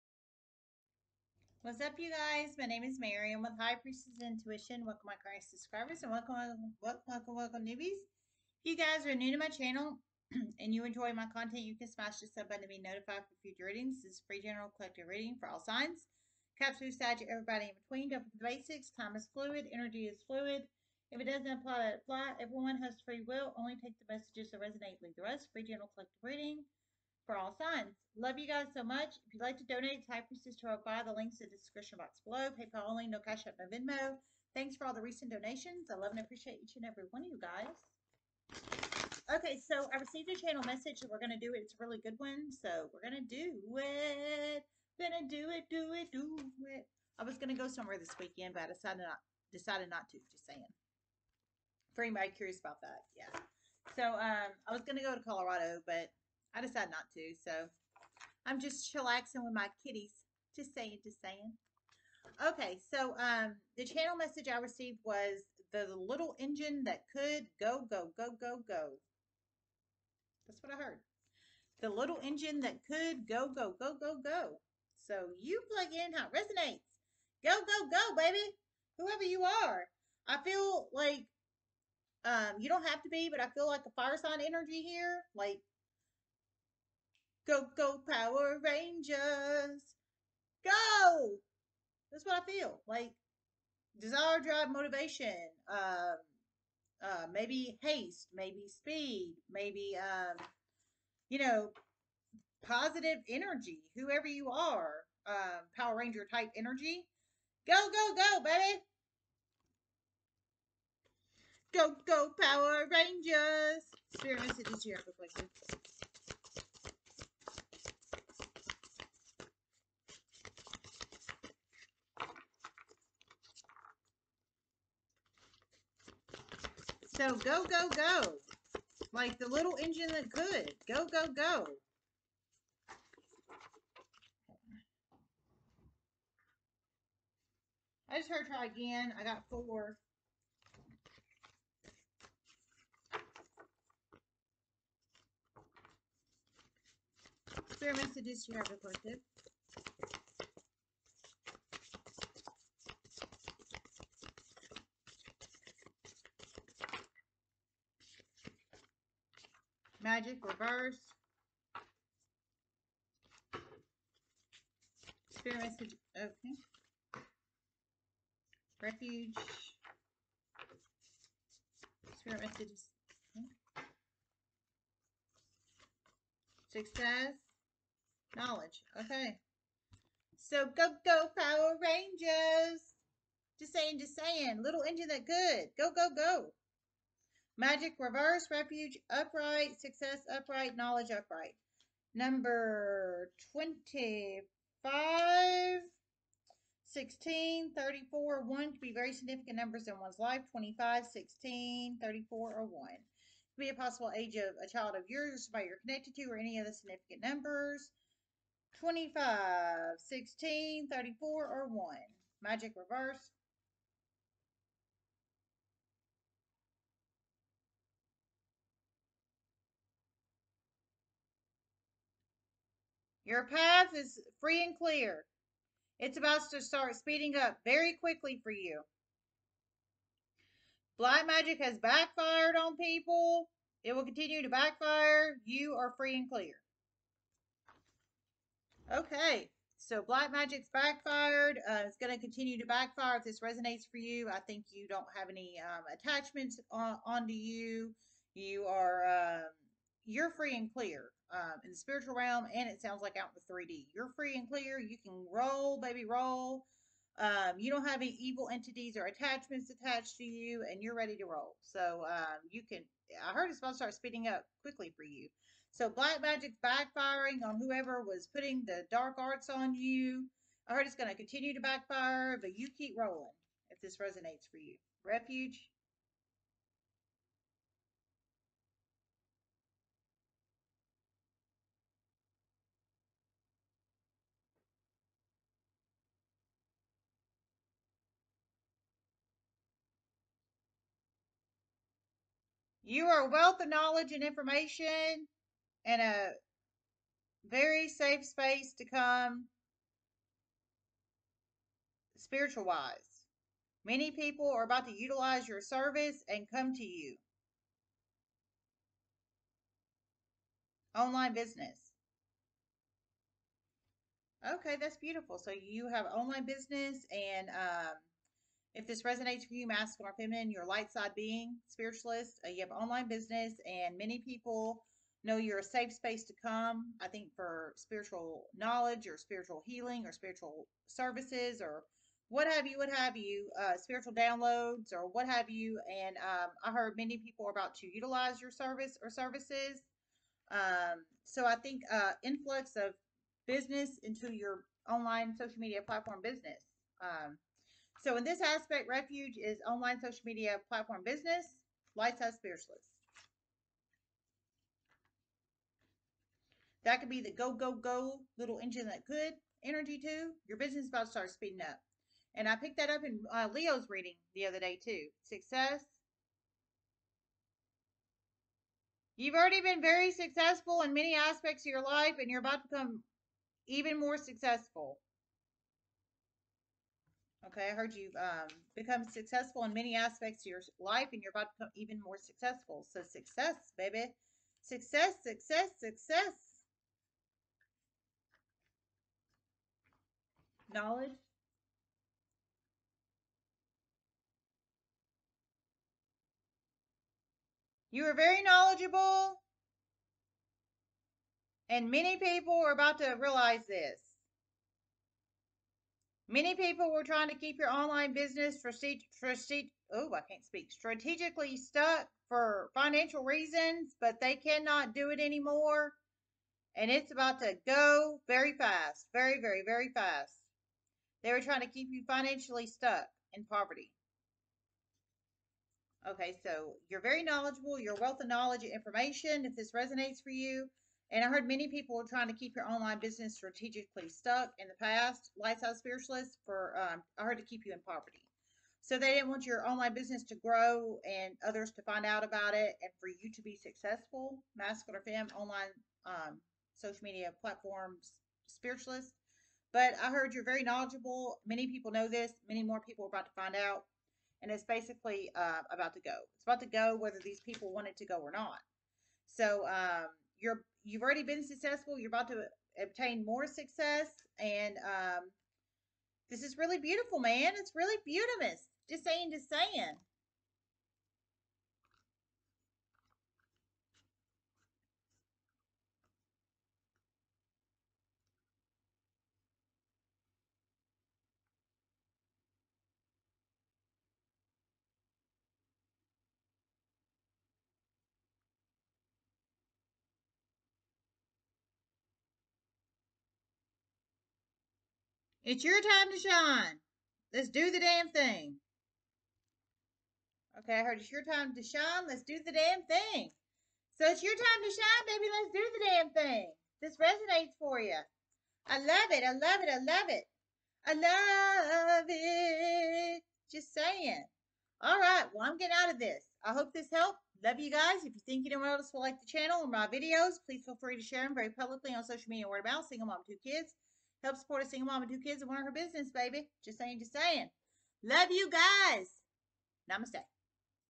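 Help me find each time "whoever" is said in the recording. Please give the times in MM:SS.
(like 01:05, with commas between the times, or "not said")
01:18, 01:43, 04:27.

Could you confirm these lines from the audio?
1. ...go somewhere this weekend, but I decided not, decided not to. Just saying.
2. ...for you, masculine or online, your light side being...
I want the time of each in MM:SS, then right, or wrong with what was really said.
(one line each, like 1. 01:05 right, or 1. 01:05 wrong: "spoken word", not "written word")
1. 00:47 right
2. 05:19 wrong: "feminine", not "online".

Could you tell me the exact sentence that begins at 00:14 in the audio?
This is free general collective reading for all signs.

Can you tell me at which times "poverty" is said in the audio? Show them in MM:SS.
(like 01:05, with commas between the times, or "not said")
07:03, 07:17.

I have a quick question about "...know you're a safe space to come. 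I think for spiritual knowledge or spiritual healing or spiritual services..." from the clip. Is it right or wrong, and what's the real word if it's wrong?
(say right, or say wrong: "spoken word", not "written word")
right.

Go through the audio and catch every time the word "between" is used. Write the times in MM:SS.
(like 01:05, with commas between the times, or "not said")
00:17.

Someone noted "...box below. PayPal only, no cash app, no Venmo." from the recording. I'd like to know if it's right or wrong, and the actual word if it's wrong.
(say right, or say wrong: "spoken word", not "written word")
right.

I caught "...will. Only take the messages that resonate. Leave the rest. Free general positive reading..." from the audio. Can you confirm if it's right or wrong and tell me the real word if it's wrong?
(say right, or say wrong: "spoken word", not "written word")
wrong: "collective", not "positive".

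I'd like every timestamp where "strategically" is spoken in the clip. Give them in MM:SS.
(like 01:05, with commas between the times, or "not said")
06:50, 07:13.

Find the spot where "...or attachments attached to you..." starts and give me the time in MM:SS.
04:18.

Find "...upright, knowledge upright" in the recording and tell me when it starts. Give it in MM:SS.
03:10.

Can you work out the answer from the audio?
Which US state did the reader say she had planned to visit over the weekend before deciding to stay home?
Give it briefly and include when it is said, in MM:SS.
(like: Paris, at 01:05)
Colorado, at 00:55.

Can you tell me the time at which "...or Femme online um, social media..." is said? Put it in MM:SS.
07:24.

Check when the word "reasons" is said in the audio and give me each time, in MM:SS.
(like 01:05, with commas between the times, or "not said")
06:53.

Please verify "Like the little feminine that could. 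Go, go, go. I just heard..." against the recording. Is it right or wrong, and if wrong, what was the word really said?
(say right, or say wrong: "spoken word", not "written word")
wrong: "engine", not "feminine".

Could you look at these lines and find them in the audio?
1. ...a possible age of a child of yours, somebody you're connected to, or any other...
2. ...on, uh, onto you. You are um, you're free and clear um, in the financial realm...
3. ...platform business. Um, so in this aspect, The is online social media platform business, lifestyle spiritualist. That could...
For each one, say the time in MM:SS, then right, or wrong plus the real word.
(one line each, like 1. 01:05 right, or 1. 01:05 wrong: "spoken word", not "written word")
1. 03:23 right
2. 04:06 wrong: "spiritual", not "financial"
3. 05:45 wrong: "Refuge", not "The".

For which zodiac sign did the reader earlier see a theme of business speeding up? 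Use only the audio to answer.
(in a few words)
Leo.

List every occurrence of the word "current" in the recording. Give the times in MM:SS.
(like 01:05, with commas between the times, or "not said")
00:05.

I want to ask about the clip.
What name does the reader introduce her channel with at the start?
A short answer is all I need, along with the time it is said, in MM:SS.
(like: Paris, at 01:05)
High Priestess Intuition, at 00:03.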